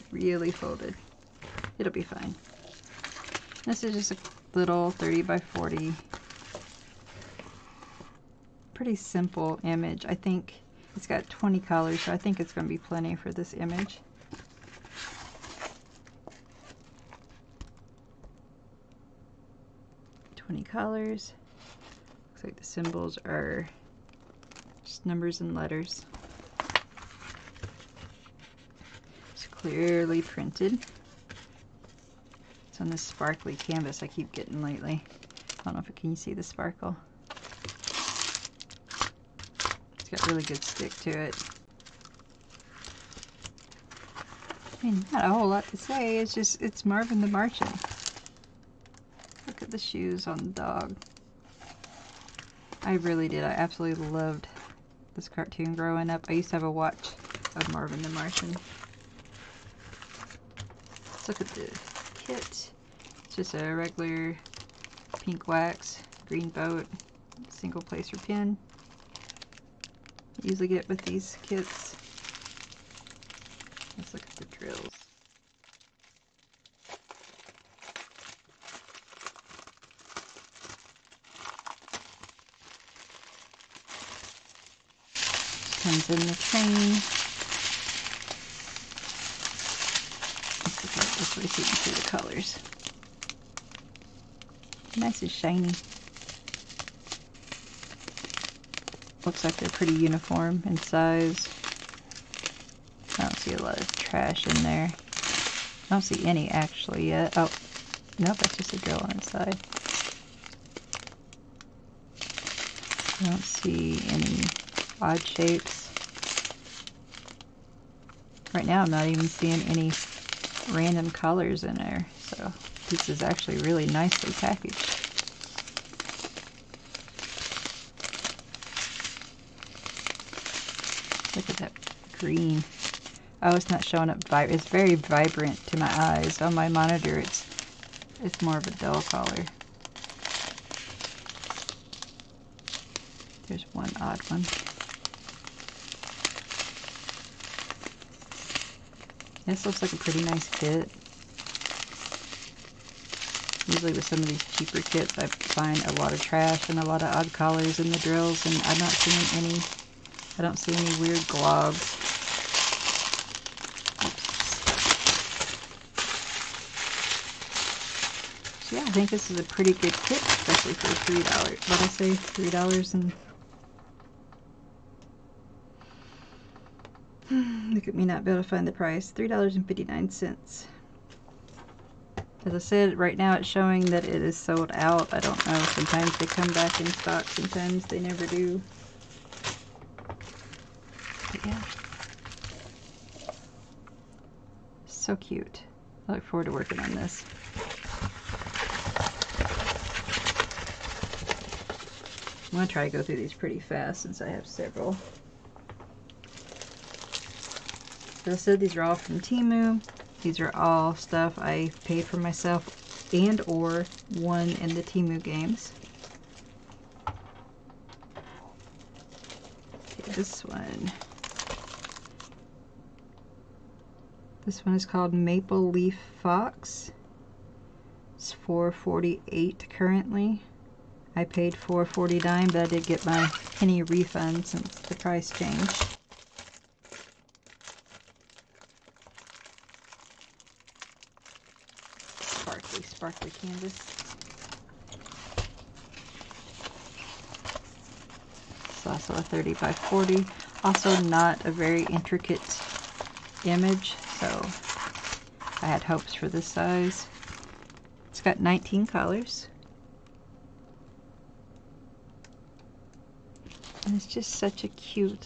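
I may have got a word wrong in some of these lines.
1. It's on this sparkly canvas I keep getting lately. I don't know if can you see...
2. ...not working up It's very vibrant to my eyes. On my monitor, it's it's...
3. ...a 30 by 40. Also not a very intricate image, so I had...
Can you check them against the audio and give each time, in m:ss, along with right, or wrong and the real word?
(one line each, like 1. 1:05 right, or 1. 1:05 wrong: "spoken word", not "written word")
1. 0:32 right
2. 2:13 wrong: "showing", not "working"
3. 4:09 right.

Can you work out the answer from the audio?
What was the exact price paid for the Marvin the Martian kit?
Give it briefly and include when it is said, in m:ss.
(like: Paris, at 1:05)
$3.59, at 2:59.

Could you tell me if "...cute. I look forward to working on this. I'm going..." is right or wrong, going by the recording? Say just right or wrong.
right.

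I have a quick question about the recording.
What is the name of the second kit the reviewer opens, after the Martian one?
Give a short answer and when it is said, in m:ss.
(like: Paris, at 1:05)
Maple Leaf Fox, at 3:45.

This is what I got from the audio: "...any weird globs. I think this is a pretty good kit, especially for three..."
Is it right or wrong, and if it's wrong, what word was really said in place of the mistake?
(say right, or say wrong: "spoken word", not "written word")
right.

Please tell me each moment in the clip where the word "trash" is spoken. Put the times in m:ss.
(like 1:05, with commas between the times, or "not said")
1:43, 2:36.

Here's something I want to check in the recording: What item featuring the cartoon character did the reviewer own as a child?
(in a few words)
A watch.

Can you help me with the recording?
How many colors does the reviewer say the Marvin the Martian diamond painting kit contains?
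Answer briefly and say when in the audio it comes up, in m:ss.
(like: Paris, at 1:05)
20, at 0:11.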